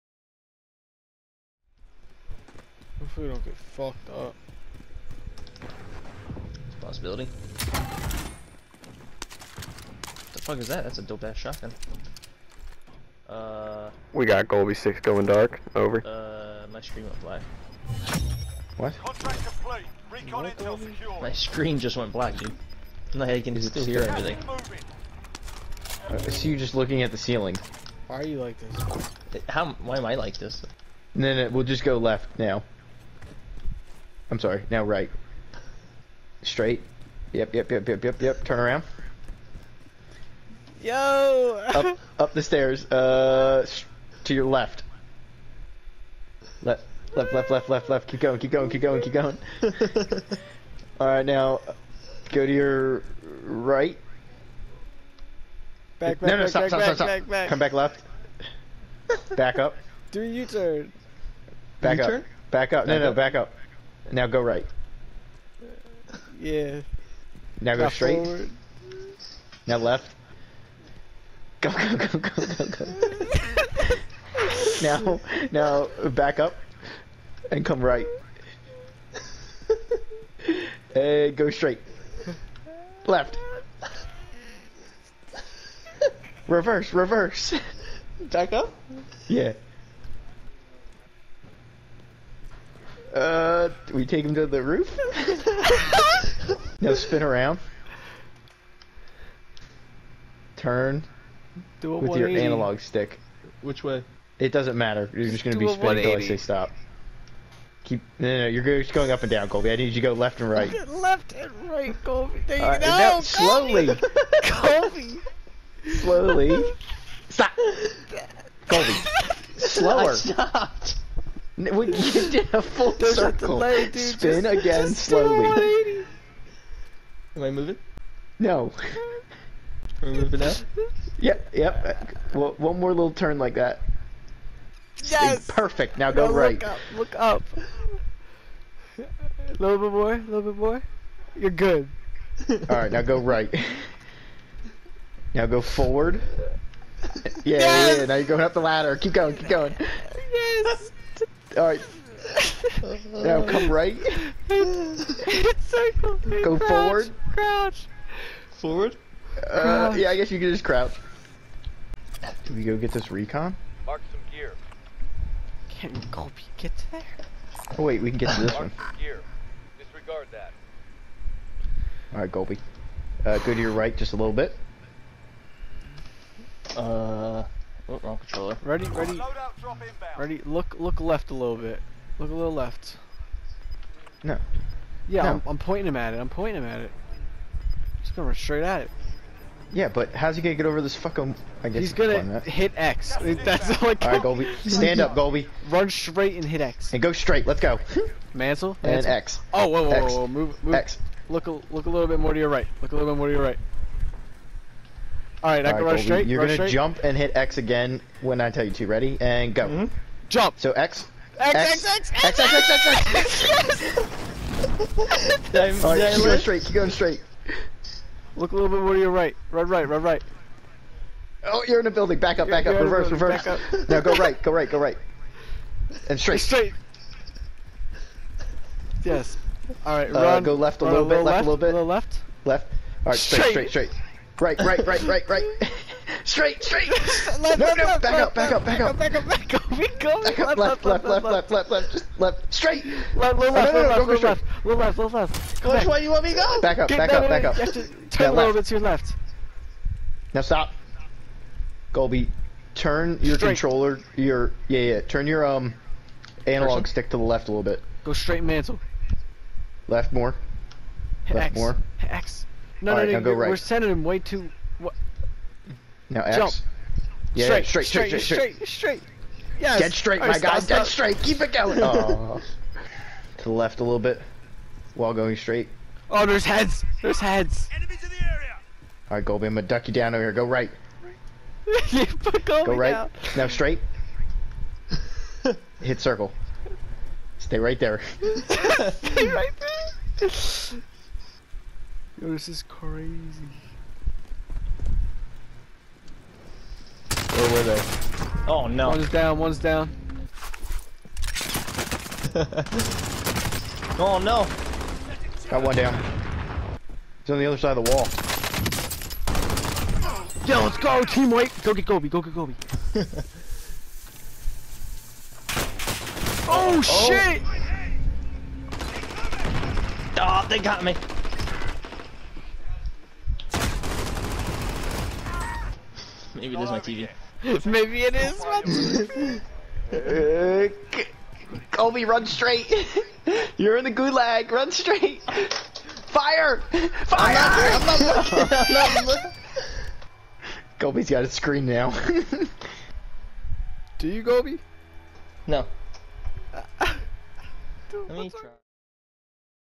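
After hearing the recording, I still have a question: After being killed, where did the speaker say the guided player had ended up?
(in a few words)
the gulag.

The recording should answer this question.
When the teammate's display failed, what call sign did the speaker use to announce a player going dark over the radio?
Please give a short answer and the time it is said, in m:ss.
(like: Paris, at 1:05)
Golbie 6, at 0:14.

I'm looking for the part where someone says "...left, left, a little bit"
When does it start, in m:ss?
3:51.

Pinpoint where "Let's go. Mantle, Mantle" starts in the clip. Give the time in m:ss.
3:17.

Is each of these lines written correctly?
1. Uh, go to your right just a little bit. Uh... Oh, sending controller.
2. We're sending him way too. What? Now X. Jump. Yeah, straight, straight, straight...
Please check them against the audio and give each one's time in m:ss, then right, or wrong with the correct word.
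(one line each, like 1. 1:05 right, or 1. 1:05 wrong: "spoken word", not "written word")
1. 2:53 wrong: "wrong", not "sending"
2. 4:23 right.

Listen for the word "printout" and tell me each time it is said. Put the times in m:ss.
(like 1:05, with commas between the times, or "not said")
not said.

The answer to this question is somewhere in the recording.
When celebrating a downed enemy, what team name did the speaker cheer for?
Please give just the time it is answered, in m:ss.
5:11.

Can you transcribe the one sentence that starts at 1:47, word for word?
Keep no, no, no, you're just going up and down, Colby.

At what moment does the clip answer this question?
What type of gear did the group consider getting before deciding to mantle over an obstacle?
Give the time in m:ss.
2:43.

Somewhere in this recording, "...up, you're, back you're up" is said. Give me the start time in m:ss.
3:42.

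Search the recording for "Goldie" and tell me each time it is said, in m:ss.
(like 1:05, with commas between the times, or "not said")
4:39.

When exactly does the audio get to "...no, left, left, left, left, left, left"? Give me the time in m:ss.
4:04.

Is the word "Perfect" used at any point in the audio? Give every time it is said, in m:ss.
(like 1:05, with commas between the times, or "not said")
2:15.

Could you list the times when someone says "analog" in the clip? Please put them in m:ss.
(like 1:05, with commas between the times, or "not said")
1:42, 4:16.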